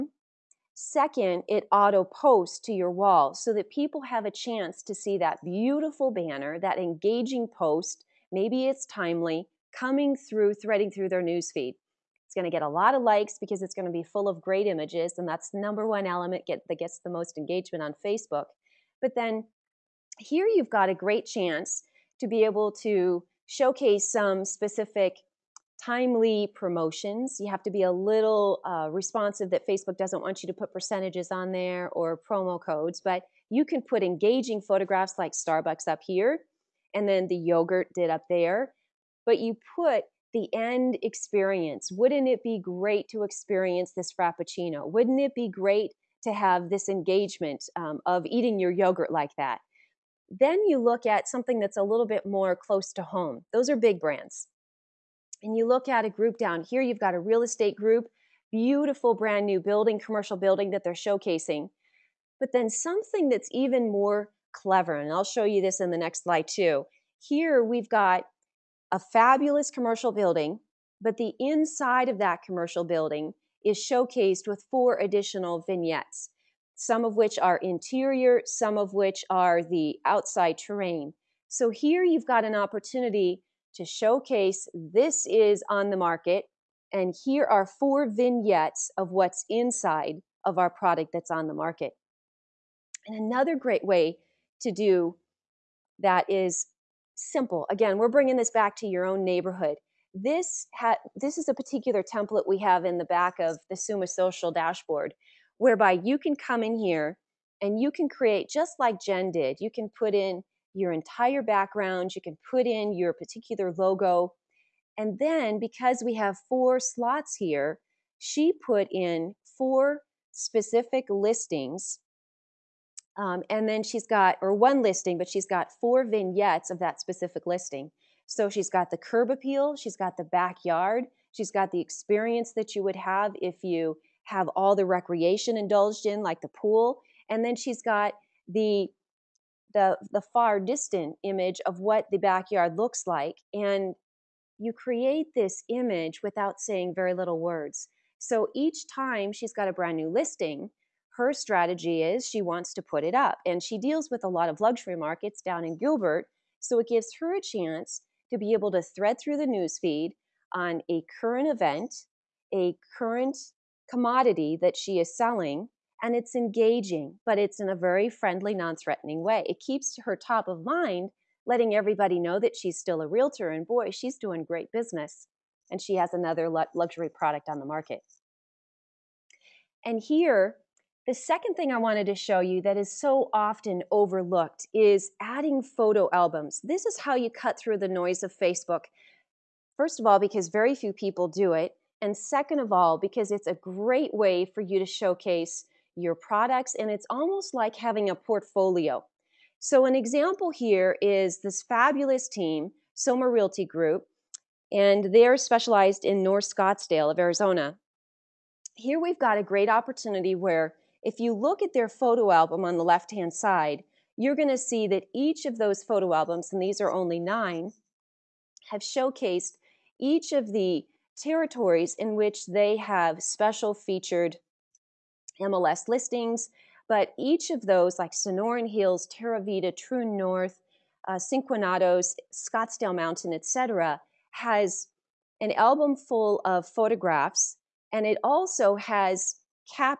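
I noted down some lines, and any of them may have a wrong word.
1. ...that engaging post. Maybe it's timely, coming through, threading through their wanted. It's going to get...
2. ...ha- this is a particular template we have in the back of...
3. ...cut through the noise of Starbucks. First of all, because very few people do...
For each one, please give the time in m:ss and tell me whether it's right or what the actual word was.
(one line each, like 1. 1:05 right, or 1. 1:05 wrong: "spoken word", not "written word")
1. 0:06 wrong: "newsfeed", not "wanted"
2. 1:40 right
3. 3:07 wrong: "Facebook", not "Starbucks".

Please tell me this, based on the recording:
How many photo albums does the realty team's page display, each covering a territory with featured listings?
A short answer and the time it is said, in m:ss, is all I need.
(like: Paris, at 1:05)
9, at 3:37.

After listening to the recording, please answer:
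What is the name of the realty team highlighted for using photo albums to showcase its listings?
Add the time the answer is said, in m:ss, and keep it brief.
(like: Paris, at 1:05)
Soma Realty Group, at 3:22.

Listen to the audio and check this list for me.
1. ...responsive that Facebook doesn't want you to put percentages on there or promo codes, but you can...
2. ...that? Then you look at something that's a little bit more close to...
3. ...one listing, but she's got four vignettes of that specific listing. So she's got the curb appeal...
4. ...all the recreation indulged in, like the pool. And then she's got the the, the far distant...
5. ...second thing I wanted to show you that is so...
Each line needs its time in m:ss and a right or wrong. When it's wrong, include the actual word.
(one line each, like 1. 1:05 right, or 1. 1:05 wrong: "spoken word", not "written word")
1. 0:28 right
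2. 0:49 right
3. 2:04 right
4. 2:14 right
5. 3:01 right.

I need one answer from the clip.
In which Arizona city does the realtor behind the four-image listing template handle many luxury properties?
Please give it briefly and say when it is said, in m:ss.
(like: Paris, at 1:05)
Gilbert, at 2:35.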